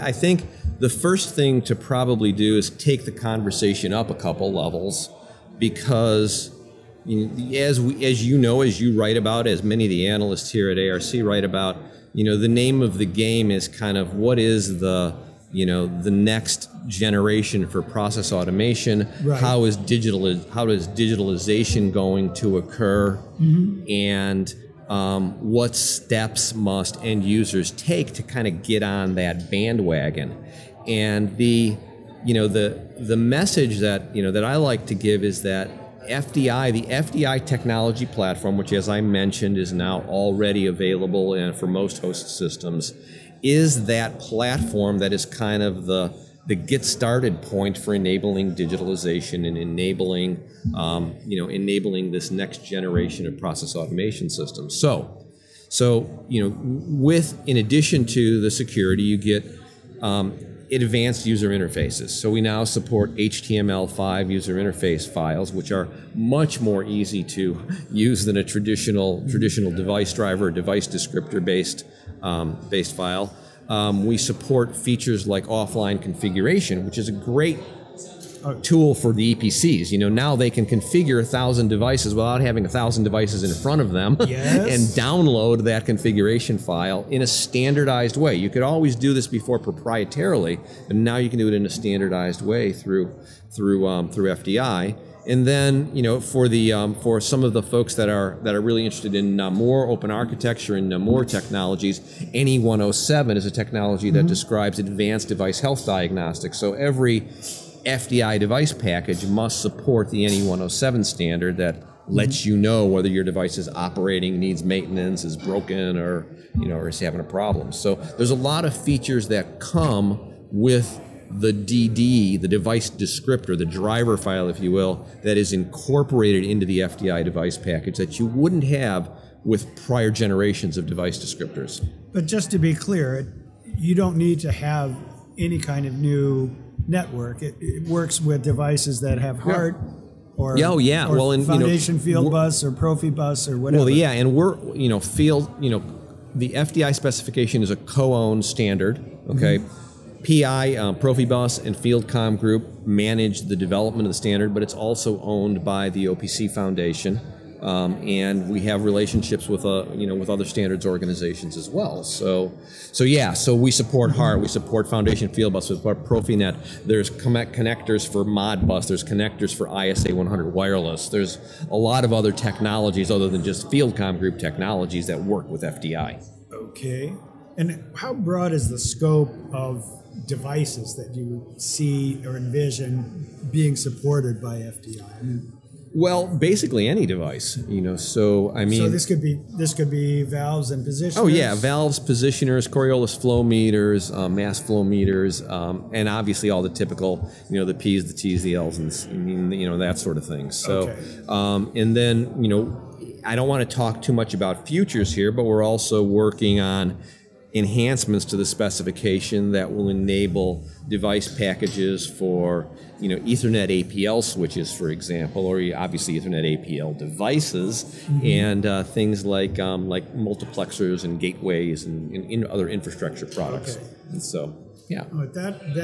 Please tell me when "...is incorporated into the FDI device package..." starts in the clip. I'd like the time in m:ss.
2:05.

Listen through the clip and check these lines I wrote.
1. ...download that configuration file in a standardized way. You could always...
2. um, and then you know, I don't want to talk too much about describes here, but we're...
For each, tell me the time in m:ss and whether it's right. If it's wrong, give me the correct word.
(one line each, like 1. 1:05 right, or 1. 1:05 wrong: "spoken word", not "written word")
1. 1:25 right
2. 3:21 wrong: "futures", not "describes".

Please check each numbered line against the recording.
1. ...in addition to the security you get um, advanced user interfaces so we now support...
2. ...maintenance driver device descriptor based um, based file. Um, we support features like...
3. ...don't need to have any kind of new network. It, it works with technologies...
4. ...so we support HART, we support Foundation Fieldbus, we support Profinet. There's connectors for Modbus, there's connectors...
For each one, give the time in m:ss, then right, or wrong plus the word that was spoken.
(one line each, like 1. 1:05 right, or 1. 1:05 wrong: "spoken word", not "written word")
1. 0:57 right
2. 1:09 wrong: "device", not "maintenance"
3. 2:13 wrong: "devices", not "technologies"
4. 2:43 right.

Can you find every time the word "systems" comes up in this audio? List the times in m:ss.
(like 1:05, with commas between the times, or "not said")
0:42, 0:54.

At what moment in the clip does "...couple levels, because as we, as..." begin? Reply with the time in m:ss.
0:04.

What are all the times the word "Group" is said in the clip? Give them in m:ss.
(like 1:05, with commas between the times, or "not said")
2:32, 2:54.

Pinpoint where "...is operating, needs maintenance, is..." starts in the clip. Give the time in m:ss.
1:53.